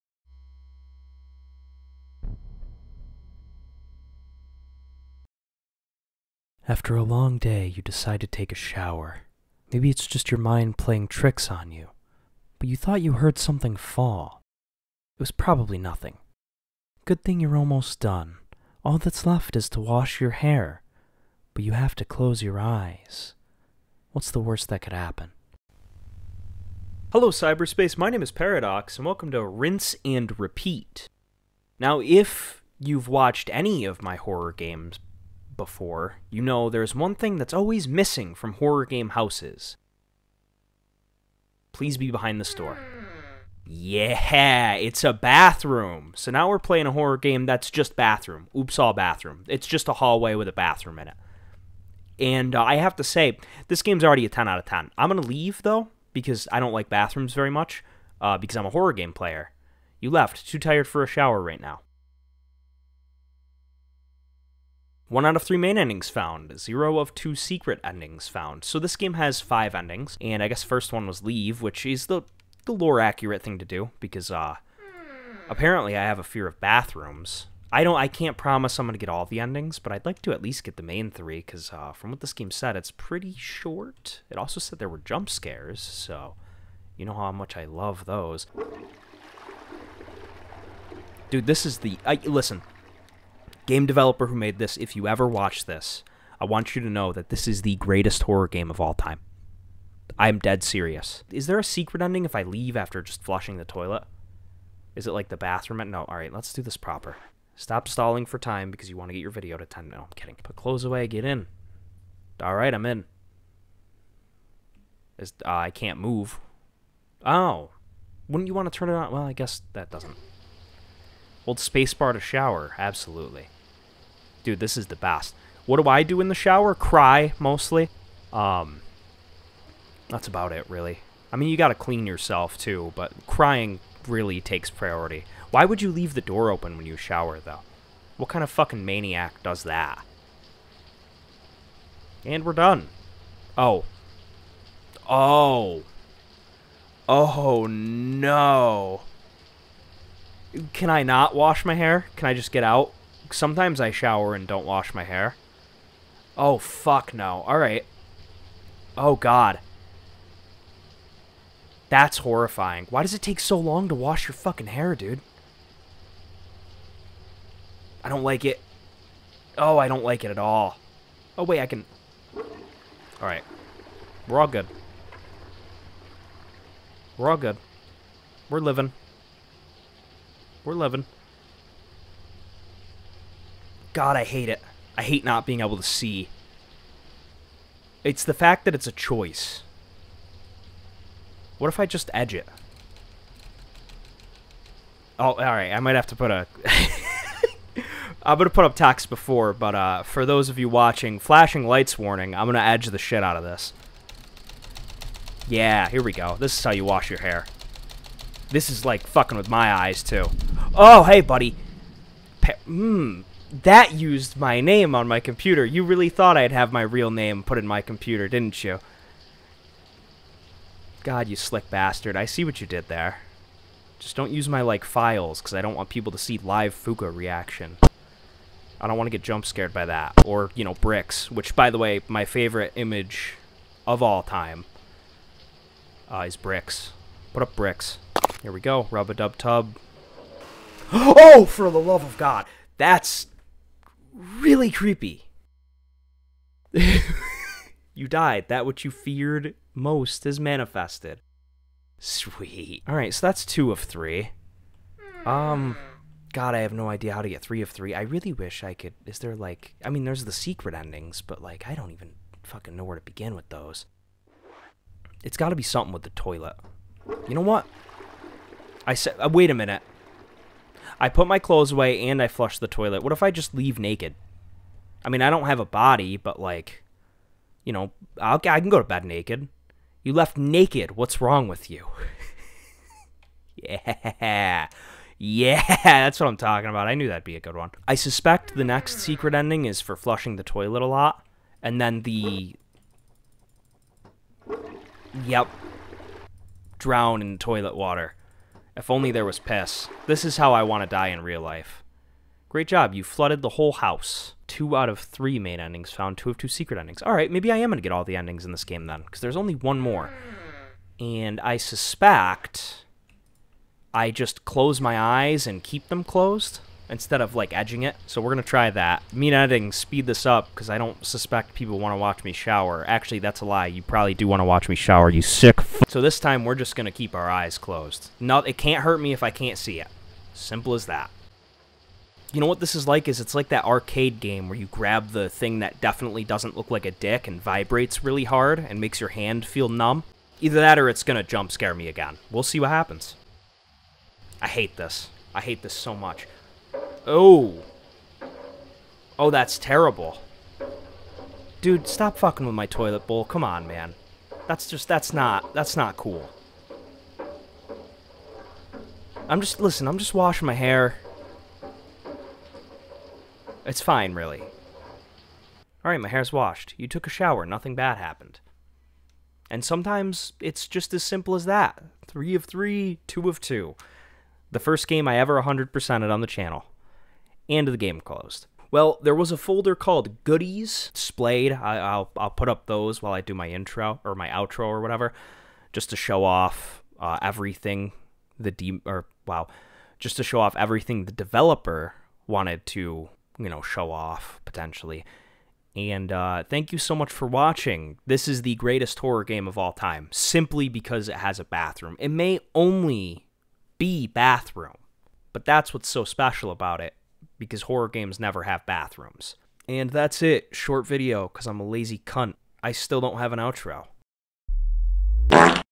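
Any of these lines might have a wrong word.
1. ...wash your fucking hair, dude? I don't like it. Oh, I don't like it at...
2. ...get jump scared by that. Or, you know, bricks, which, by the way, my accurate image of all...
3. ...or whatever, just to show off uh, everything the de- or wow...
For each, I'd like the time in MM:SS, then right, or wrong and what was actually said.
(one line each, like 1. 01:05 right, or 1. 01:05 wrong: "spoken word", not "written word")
1. 02:43 right
2. 03:49 wrong: "favorite", not "accurate"
3. 06:24 right.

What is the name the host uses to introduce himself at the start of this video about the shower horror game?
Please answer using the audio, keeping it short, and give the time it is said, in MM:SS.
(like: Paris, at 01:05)
Paradox, at 00:28.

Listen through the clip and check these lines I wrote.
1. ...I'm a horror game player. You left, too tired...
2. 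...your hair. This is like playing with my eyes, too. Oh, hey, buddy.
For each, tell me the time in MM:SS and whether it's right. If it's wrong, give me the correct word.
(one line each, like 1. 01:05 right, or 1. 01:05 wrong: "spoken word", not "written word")
1. 00:58 right
2. 03:27 wrong: "fucking", not "playing".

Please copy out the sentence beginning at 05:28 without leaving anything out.
No, it can't hurt me if I can't see it.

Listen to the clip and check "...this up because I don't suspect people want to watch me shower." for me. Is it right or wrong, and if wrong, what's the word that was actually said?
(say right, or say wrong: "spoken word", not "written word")
right.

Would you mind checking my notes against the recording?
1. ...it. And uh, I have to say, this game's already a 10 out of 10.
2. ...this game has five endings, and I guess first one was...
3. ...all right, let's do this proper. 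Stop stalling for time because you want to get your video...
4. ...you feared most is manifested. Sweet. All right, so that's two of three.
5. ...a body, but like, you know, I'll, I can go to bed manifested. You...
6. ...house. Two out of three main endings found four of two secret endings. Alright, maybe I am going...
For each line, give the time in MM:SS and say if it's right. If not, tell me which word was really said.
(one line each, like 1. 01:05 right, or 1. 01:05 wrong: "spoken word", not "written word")
1. 00:51 right
2. 01:08 right
3. 01:46 right
4. 04:08 right
5. 04:35 wrong: "naked", not "manifested"
6. 05:03 wrong: "two", not "four".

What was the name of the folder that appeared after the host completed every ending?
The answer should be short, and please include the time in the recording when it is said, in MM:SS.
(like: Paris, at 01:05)
Goodies, at 06:20.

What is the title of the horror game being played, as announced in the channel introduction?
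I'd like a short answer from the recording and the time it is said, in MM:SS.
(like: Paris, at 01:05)
Rinse and Repeat, at 00:29.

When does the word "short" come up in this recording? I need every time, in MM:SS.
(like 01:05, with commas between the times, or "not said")
01:23, 06:50.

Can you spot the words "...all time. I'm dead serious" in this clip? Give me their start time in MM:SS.
01:38.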